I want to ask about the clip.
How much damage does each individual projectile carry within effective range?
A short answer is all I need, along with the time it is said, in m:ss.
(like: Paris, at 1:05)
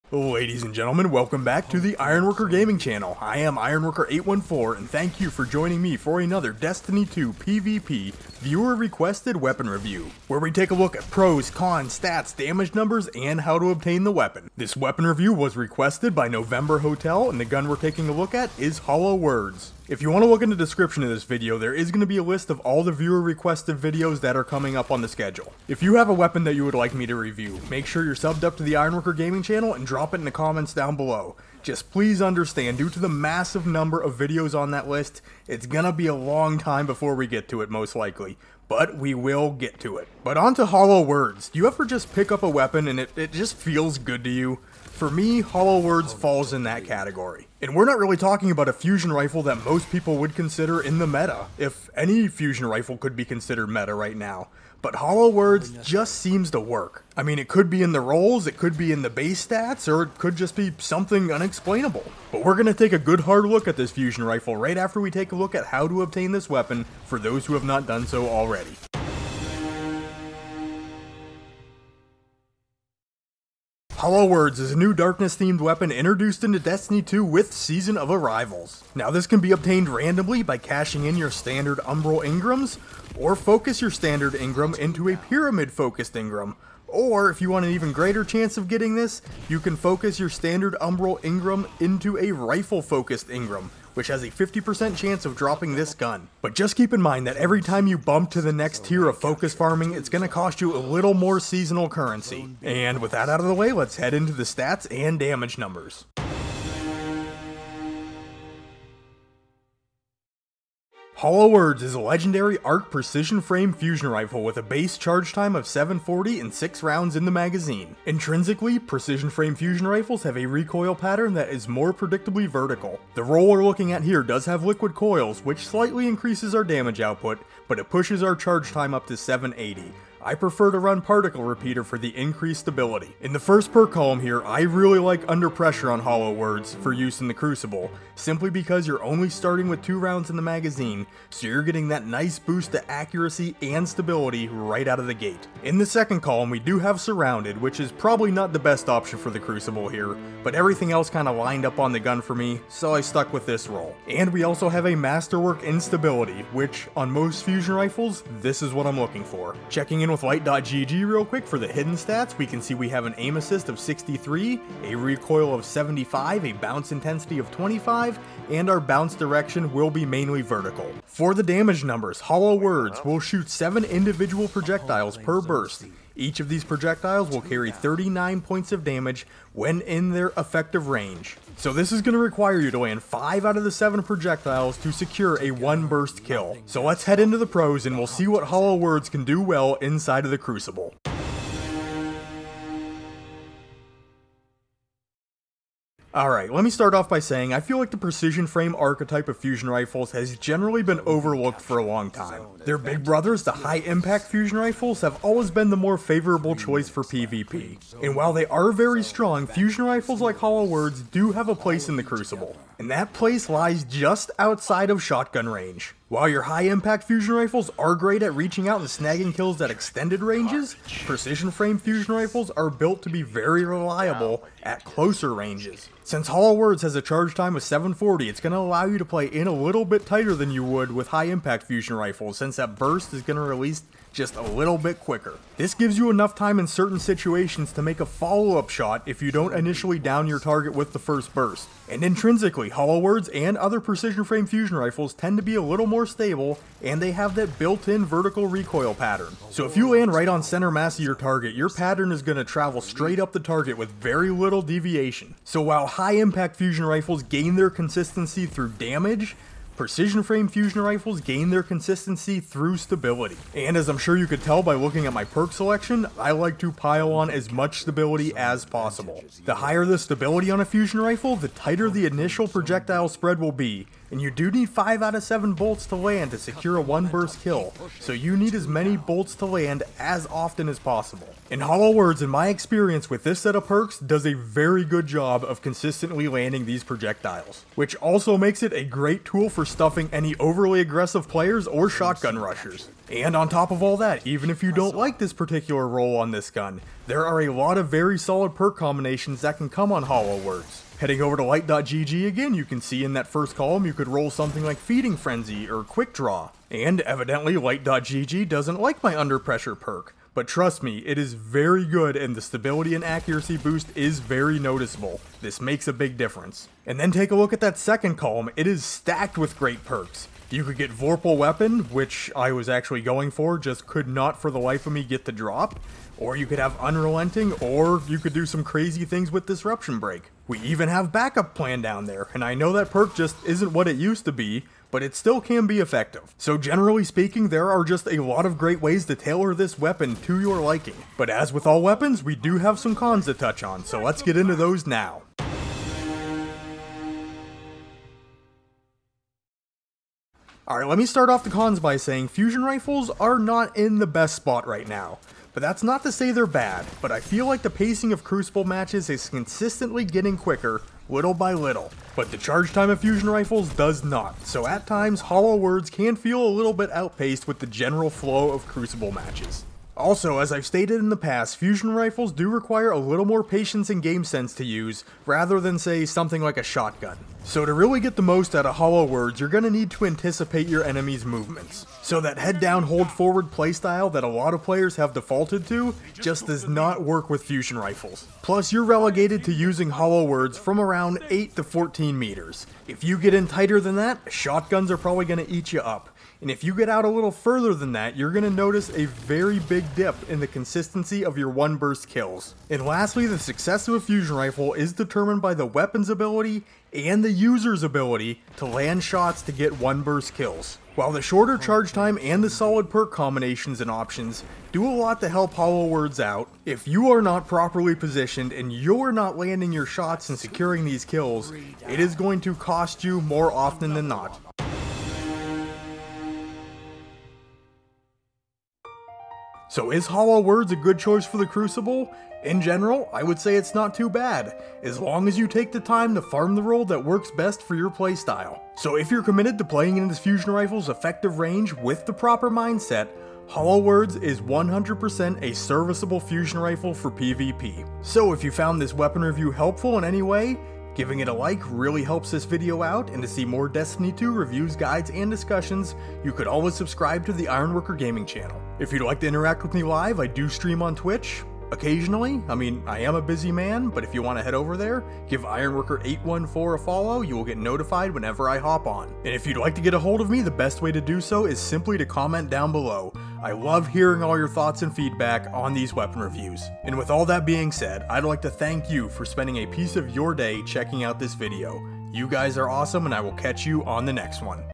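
39, at 2:57.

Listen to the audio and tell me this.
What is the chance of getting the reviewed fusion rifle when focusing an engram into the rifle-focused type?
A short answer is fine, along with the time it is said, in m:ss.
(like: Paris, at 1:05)
50%, at 1:34.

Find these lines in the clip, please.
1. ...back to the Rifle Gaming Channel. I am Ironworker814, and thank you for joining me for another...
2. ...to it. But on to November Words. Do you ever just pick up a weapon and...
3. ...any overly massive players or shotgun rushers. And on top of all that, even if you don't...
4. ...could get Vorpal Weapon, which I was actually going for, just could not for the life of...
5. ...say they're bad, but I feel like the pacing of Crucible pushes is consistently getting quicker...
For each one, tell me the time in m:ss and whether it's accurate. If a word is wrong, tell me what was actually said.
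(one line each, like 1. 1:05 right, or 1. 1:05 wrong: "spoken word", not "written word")
1. 0:01 wrong: "Ironworker", not "Rifle"
2. 0:39 wrong: "Hollow", not "November"
3. 4:50 wrong: "aggressive", not "massive"
4. 5:20 right
5. 5:56 wrong: "matches", not "pushes".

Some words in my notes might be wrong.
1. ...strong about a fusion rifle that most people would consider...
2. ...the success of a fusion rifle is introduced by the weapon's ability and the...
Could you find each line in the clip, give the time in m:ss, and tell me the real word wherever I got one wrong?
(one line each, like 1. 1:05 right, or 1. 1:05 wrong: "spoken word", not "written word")
1. 0:48 wrong: "talking", not "strong"
2. 6:43 wrong: "determined", not "introduced".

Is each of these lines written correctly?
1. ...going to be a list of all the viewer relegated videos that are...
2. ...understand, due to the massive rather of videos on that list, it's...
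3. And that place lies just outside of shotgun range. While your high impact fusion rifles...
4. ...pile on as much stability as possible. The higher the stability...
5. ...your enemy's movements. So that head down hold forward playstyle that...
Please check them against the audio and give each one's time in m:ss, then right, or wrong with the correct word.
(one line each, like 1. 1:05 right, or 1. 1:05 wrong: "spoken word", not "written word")
1. 0:21 wrong: "requested", not "relegated"
2. 0:32 wrong: "number", not "rather"
3. 3:32 right
4. 4:26 right
5. 6:20 right.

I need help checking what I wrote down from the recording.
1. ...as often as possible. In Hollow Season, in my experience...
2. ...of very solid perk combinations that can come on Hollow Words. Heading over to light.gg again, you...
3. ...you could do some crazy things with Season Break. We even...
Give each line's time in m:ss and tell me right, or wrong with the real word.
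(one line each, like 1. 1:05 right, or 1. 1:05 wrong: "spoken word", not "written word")
1. 4:39 wrong: "Words", not "Season"
2. 4:57 right
3. 5:28 wrong: "Disruption", not "Season".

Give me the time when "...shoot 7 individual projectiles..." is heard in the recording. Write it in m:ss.
2:53.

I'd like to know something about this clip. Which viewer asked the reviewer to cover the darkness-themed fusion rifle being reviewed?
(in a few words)
November Hotel.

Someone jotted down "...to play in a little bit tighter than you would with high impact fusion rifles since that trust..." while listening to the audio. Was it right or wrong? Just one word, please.
wrong.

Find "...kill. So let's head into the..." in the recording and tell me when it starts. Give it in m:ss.
3:06.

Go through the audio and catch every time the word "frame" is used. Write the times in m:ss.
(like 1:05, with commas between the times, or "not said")
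1:53, 1:59, 3:18, 3:41, 4:04, 4:20.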